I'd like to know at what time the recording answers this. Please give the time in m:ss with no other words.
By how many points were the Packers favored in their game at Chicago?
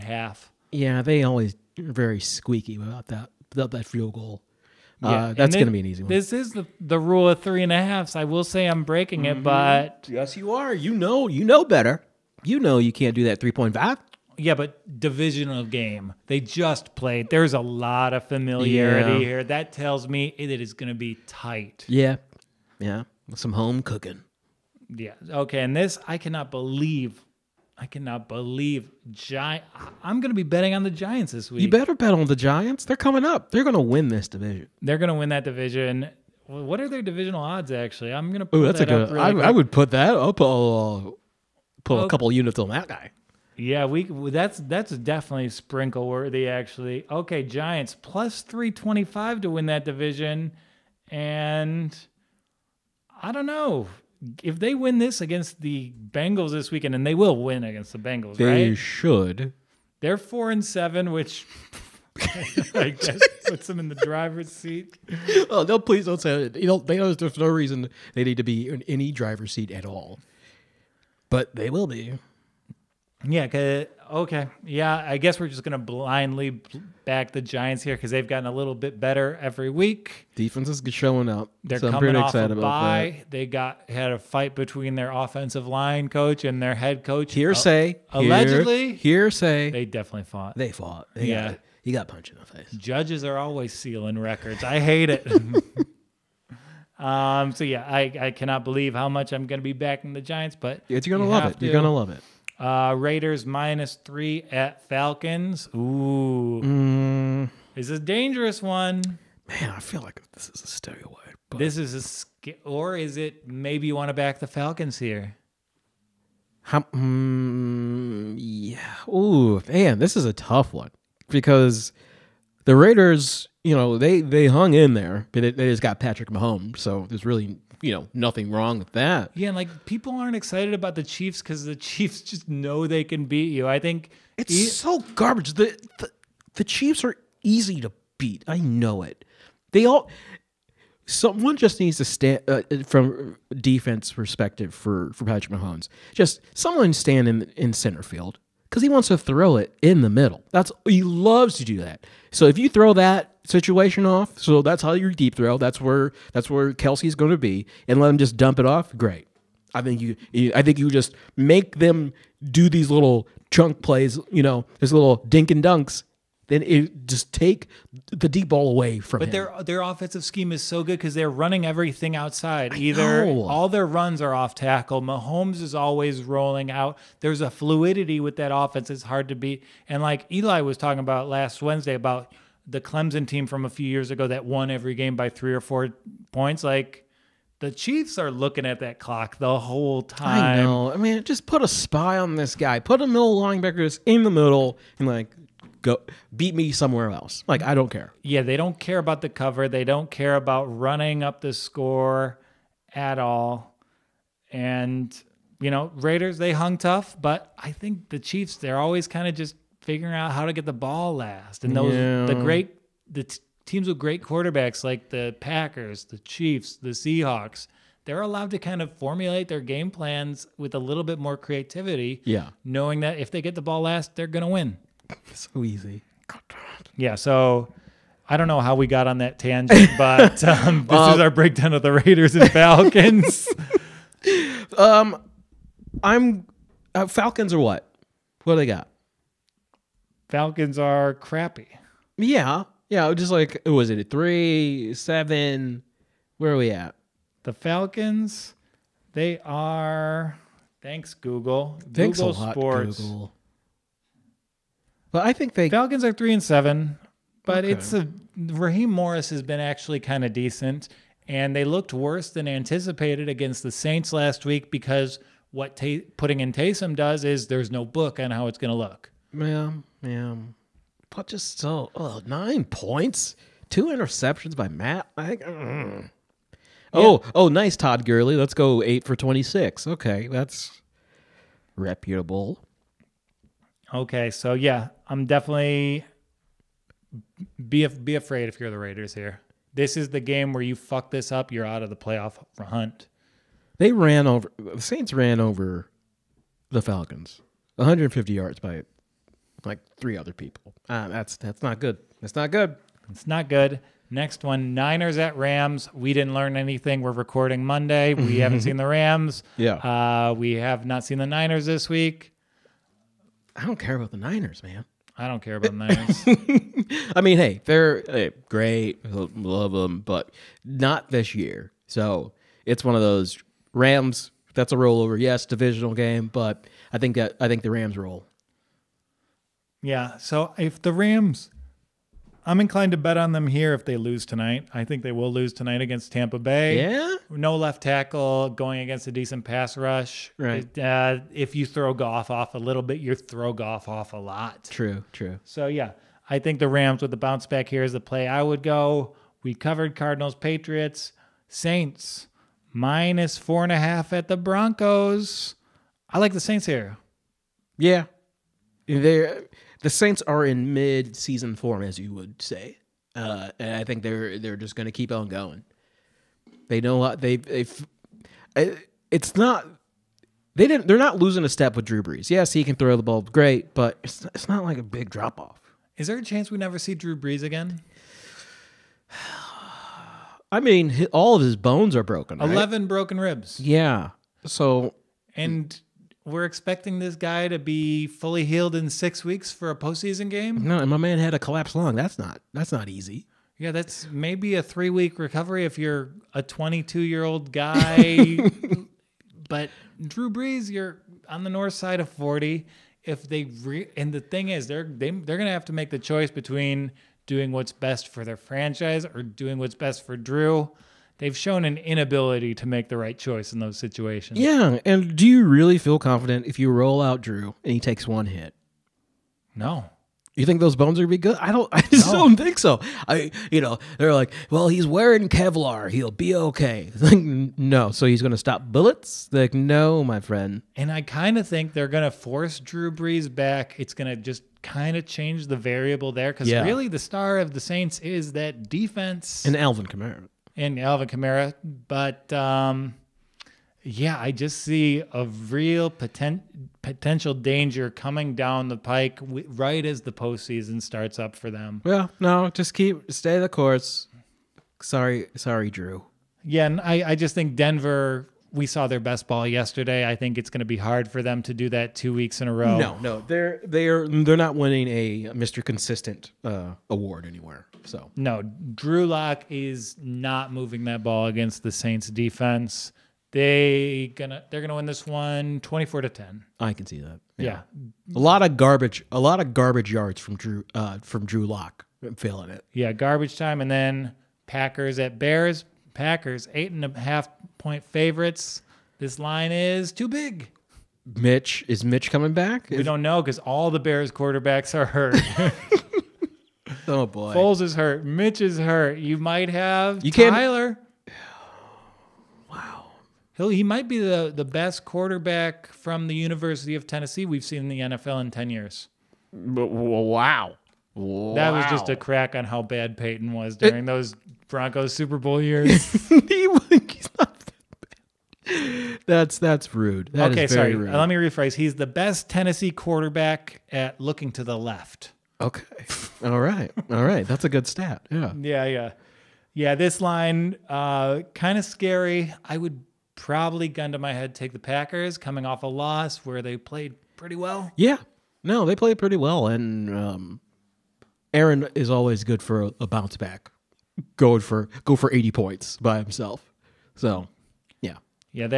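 8:06.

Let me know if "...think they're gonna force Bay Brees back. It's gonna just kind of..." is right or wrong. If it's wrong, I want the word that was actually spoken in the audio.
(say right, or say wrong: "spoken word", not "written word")
wrong: "Drew", not "Bay".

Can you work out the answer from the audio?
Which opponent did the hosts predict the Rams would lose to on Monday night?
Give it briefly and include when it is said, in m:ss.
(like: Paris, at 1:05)
Tampa Bay, at 5:36.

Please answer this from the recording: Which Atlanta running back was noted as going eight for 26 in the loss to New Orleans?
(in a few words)
Todd Gurley.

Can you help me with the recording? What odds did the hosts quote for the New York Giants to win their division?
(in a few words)
+325.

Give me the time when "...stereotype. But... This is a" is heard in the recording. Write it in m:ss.
1:50.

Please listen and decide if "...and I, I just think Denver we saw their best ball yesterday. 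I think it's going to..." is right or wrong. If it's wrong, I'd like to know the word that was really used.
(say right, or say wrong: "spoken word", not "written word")
right.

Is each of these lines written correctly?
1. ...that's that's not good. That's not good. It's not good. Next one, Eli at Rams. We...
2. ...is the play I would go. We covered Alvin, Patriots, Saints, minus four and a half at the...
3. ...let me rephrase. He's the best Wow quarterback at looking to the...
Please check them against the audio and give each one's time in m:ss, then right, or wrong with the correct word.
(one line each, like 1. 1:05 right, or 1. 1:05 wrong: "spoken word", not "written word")
1. 5:01 wrong: "Niners", not "Eli"
2. 5:47 wrong: "Cardinals", not "Alvin"
3. 8:40 wrong: "Tennessee", not "Wow".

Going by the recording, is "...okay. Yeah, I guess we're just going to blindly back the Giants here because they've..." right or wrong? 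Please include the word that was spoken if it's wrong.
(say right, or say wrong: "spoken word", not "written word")
right.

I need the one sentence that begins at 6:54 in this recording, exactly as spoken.
Yeah, and do you really feel confident if you roll out Drew and he takes one hit?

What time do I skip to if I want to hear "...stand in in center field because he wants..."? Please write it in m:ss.
2:26.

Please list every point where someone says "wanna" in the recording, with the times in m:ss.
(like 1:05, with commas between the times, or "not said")
not said.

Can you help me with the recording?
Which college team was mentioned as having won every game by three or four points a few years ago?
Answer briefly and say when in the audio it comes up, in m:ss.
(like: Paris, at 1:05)
Clemson, at 3:02.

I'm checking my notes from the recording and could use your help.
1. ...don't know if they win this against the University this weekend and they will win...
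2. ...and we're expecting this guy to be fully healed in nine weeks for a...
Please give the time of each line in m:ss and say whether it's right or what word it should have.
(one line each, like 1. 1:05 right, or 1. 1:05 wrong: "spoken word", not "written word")
1. 0:53 wrong: "Bengals", not "University"
2. 6:25 wrong: "six", not "nine".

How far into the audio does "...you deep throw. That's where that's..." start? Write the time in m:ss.
2:34.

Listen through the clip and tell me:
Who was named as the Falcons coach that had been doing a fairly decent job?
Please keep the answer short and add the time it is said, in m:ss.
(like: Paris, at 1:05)
Raheem Morris, at 4:18.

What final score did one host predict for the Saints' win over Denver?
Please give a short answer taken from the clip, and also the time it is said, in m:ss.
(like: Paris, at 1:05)
24 to 10, at 7:55.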